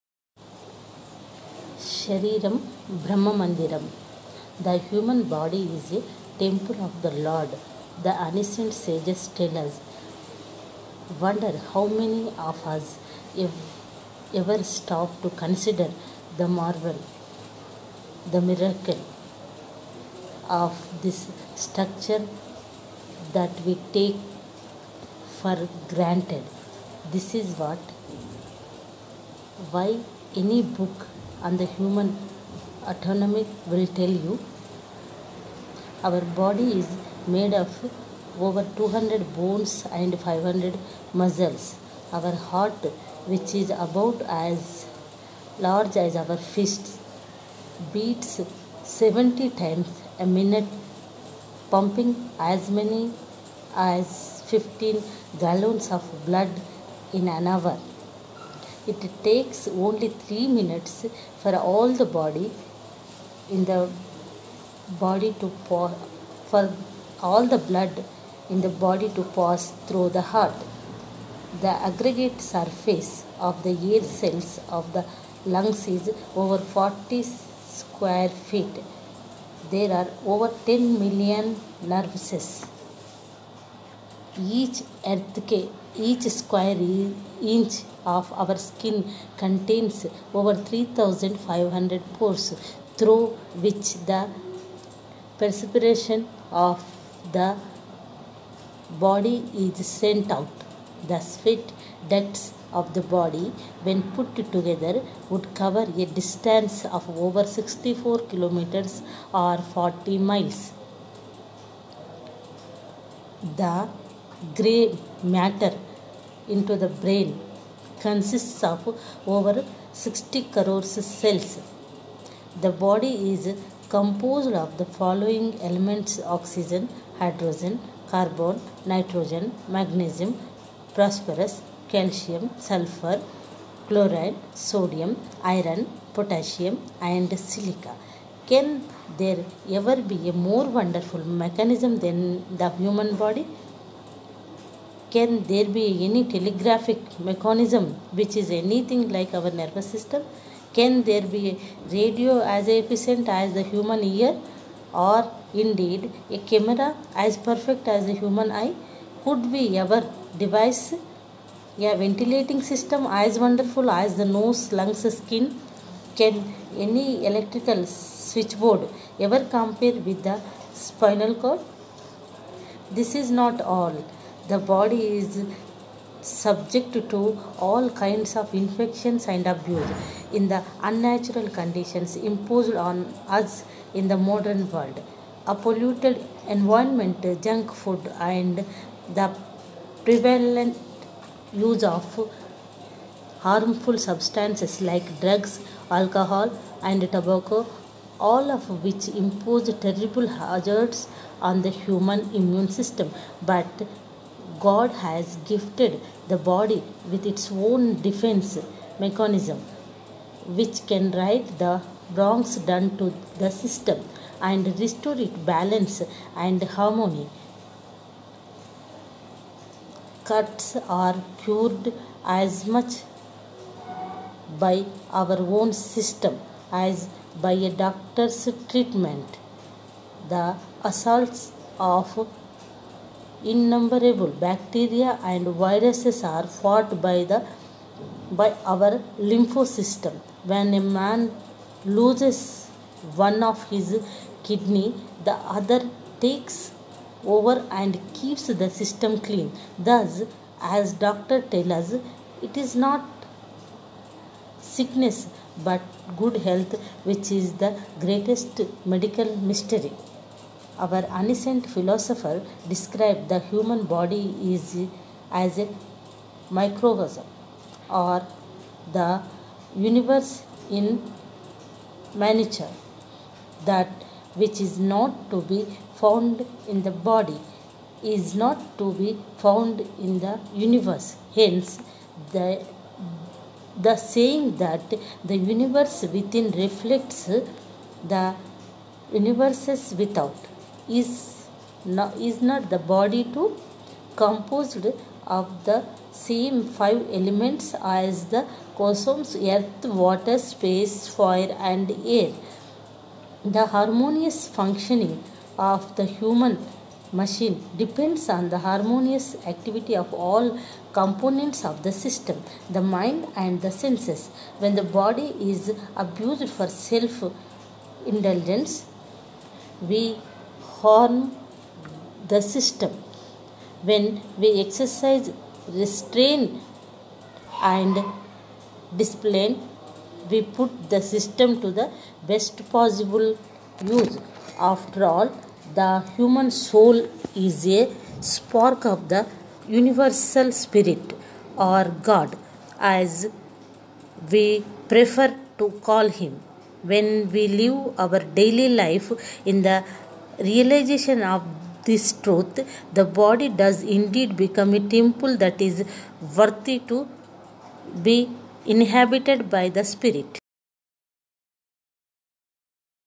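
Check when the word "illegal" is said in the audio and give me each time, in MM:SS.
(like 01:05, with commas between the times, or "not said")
not said.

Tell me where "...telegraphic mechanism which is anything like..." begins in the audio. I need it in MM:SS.
02:26.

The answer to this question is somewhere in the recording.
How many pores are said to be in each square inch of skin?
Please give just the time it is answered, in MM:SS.
01:30.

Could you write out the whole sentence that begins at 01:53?
The gray matter into the brain consists of over 60 crores cells.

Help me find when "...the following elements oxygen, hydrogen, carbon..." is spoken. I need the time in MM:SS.
02:04.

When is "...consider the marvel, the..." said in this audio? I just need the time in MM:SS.
00:15.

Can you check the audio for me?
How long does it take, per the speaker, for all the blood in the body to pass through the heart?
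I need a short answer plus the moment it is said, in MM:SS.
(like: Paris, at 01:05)
3 minutes, at 01:00.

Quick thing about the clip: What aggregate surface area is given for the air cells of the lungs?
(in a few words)
40 square feet.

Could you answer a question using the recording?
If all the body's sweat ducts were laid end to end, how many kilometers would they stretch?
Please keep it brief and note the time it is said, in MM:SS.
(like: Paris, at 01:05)
64 kilometers, at 01:47.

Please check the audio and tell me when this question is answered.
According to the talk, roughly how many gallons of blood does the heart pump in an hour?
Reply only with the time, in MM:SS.
00:54.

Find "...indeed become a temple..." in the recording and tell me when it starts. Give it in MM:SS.
05:53.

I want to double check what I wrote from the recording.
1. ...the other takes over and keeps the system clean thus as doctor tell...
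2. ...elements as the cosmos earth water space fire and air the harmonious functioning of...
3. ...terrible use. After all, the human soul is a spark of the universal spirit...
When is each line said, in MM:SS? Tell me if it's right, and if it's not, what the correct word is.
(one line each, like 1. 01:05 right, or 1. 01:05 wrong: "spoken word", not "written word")
1. 04:05 right
2. 04:57 right
3. 05:32 wrong: "possible", not "terrible".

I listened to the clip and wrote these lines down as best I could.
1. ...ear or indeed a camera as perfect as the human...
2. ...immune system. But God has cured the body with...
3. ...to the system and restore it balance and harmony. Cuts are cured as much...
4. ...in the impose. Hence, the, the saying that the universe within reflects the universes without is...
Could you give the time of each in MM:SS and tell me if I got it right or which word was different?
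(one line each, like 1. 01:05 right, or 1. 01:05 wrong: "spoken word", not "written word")
1. 02:34 right
2. 03:22 wrong: "gifted", not "cured"
3. 03:32 right
4. 04:39 wrong: "universe", not "impose".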